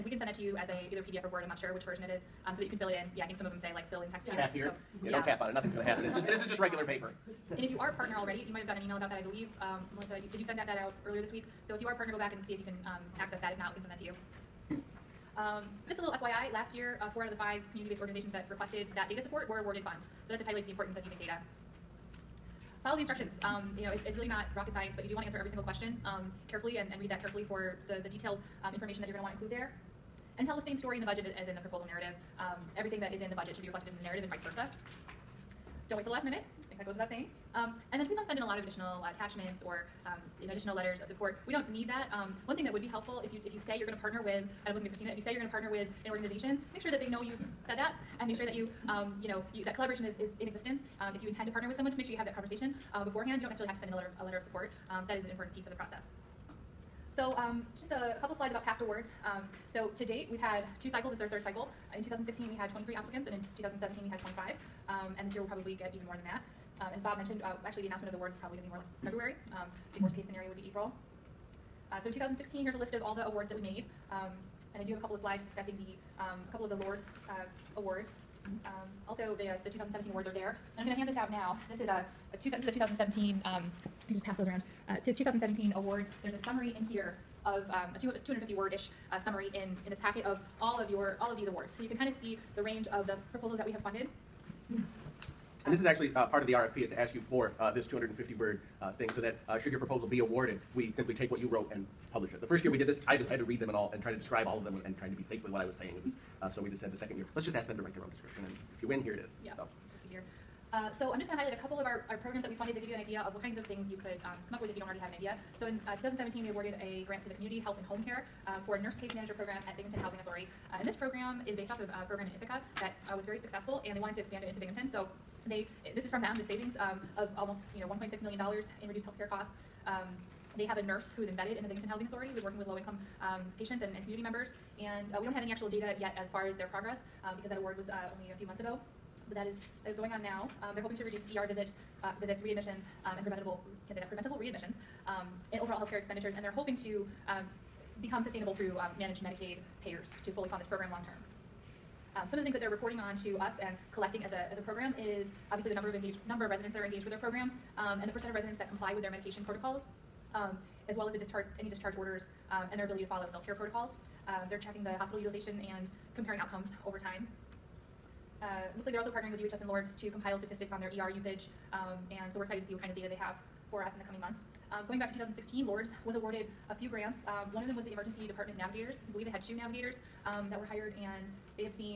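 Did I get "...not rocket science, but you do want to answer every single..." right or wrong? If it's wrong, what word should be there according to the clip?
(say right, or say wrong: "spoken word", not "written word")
right.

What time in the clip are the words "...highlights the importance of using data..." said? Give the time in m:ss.
0:20.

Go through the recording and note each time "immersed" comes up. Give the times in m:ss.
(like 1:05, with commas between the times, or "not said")
not said.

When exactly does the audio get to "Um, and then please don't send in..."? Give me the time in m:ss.
0:37.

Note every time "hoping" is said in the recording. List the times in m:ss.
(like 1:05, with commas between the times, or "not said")
2:20, 2:26.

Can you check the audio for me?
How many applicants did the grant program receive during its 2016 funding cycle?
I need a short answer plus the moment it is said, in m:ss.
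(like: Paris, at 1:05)
23, at 1:02.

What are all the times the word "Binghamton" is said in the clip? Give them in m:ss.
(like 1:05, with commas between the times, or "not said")
1:59, 2:04, 2:11.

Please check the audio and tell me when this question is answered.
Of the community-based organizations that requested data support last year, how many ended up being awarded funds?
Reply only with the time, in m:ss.
0:17.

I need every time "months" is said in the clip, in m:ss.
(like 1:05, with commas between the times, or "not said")
2:18, 2:54.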